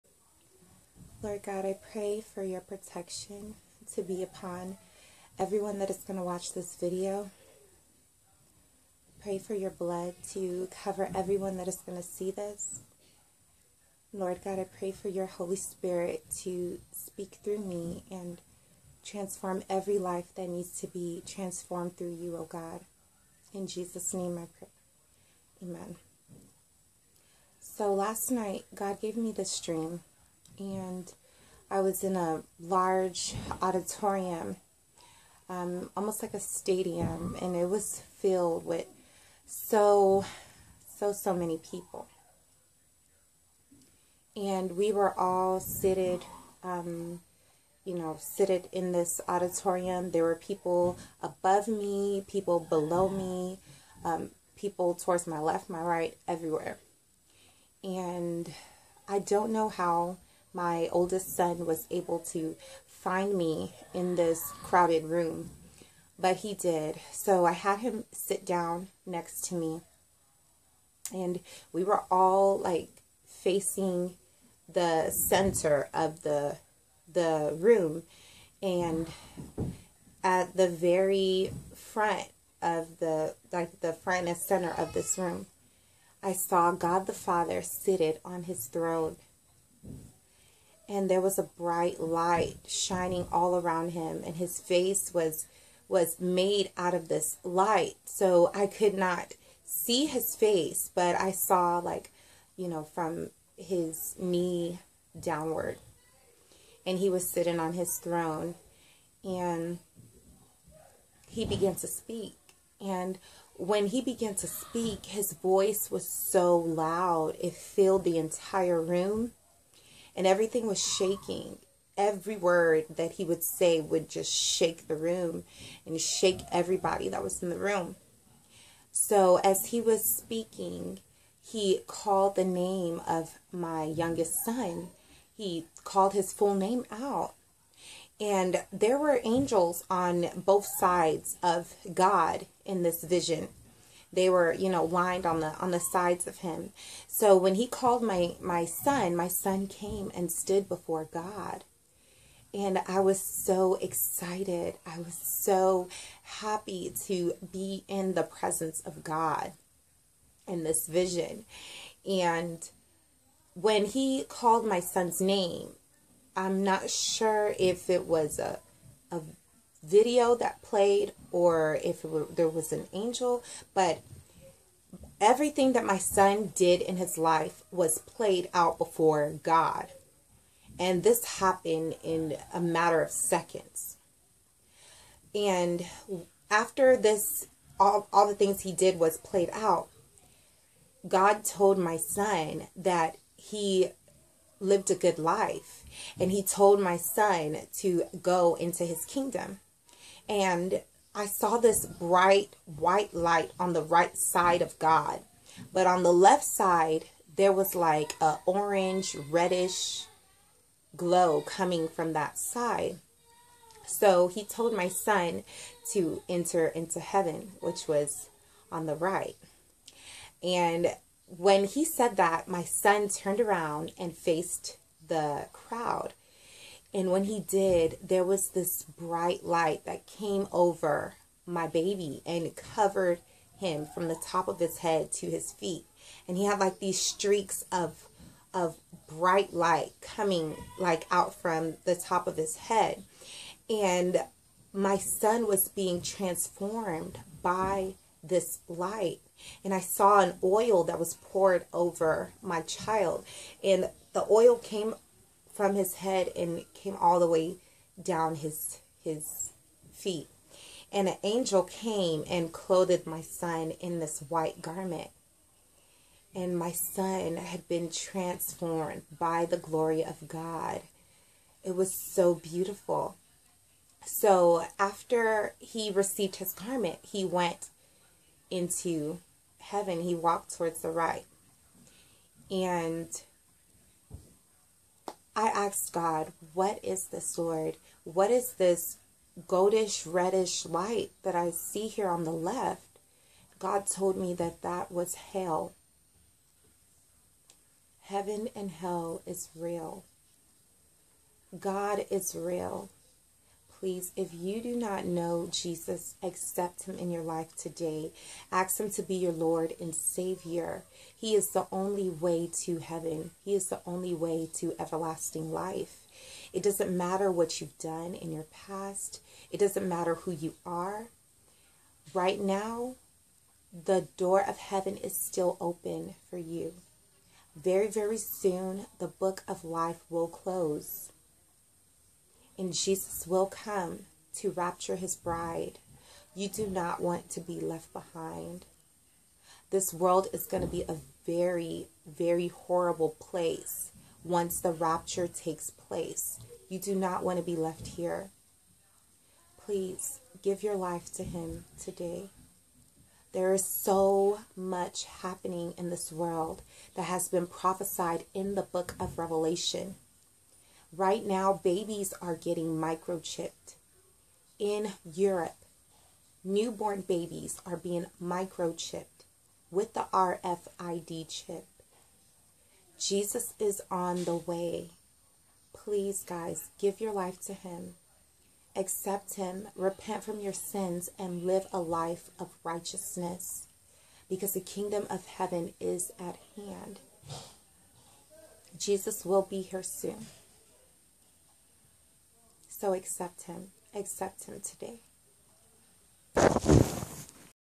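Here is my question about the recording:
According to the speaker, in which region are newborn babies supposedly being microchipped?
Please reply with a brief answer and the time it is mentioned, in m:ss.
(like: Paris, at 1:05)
Europe, at 6:05.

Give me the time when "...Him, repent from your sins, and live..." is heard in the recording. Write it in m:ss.
6:19.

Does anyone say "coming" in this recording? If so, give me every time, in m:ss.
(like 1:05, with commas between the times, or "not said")
3:31, 4:00.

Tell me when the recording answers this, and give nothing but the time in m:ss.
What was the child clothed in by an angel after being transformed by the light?
4:24.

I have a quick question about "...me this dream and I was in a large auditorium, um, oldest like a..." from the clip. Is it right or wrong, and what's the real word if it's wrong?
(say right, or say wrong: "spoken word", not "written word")
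wrong: "almost", not "oldest".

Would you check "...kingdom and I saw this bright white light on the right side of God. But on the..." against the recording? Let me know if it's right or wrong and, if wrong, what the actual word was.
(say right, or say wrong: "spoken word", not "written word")
right.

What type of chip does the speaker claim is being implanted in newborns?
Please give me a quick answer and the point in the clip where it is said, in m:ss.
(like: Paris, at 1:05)
RFID chip, at 6:10.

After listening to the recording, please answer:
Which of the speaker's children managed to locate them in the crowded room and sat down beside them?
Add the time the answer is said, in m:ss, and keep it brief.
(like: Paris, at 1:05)
oldest son, at 1:00.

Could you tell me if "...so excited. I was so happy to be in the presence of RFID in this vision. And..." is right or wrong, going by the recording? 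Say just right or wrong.
wrong.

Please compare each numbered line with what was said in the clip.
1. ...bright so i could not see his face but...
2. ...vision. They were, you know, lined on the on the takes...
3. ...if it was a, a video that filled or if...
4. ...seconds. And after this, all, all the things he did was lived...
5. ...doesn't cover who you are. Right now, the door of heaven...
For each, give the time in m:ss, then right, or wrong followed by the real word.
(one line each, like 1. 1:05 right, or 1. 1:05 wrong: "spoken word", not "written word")
1. 1:37 wrong: "light", not "bright"
2. 2:23 wrong: "sides", not "takes"
3. 2:47 wrong: "played", not "filled"
4. 3:03 wrong: "played", not "lived"
5. 5:19 wrong: "matter", not "cover".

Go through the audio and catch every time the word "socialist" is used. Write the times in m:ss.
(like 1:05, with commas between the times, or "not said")
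not said.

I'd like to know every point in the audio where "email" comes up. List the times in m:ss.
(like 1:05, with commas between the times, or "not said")
not said.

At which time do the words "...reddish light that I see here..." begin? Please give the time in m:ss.
4:50.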